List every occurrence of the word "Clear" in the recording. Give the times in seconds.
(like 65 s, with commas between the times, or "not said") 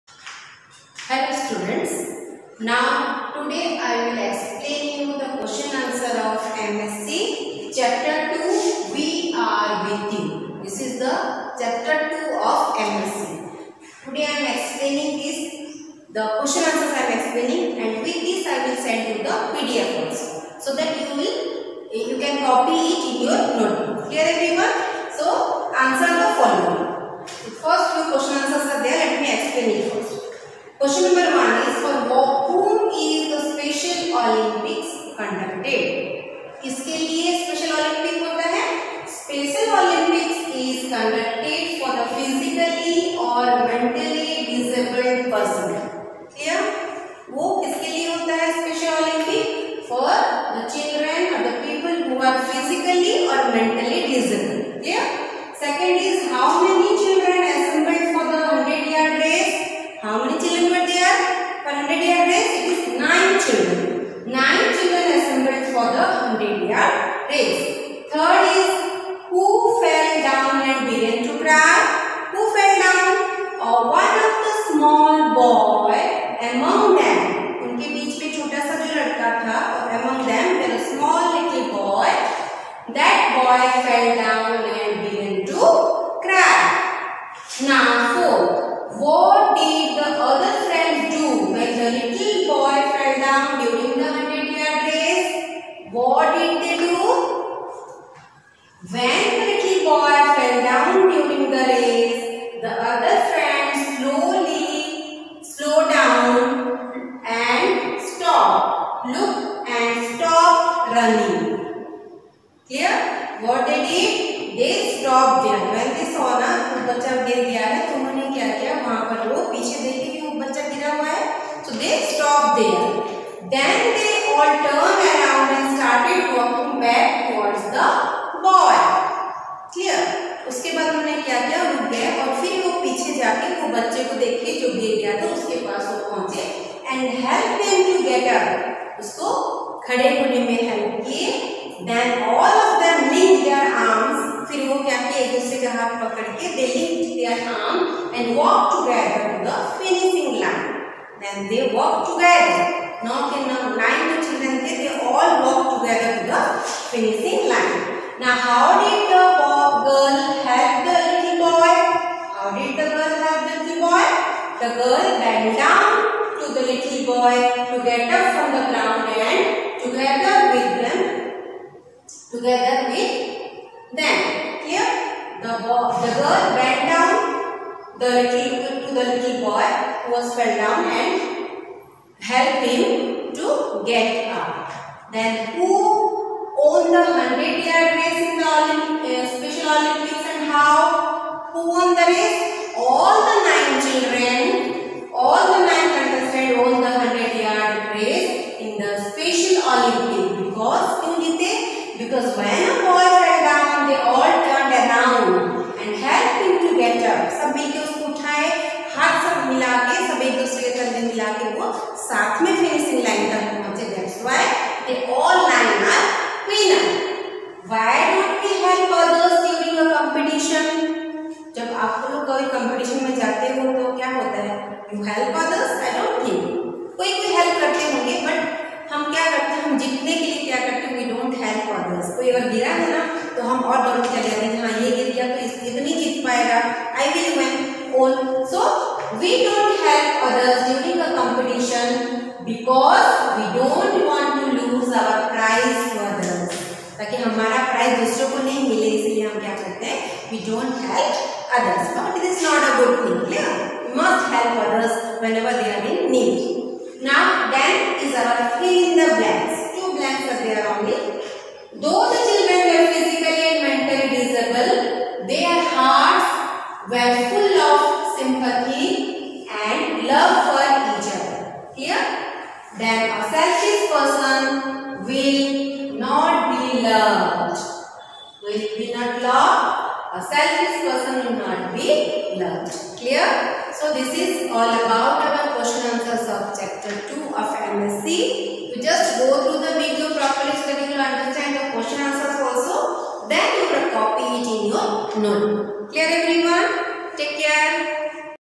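282 s.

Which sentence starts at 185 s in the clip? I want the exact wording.
Then who won the 100 yard race in the Olymp uh, Special Olympics and how?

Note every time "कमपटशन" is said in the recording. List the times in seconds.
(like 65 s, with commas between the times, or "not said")
241 s.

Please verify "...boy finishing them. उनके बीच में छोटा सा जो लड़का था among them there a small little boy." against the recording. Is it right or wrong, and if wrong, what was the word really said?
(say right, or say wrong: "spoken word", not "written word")
wrong: "among", not "finishing".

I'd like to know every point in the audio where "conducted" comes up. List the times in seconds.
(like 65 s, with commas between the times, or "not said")
35 s.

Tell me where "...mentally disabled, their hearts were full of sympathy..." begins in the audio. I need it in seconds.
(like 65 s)
263 s.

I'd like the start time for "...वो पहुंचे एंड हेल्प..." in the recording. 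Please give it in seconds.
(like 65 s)
135 s.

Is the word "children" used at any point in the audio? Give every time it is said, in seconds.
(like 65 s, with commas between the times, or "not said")
154 s, 193 s, 262 s.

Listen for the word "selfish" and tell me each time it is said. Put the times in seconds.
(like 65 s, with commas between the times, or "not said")
273 s, 280 s.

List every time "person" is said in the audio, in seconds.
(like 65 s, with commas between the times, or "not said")
273 s, 280 s.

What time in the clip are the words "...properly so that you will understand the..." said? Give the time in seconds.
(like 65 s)
290 s.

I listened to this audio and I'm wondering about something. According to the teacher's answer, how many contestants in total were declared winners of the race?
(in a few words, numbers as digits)
9.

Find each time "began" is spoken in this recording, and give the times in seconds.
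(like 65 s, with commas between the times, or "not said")
70 s, 85 s.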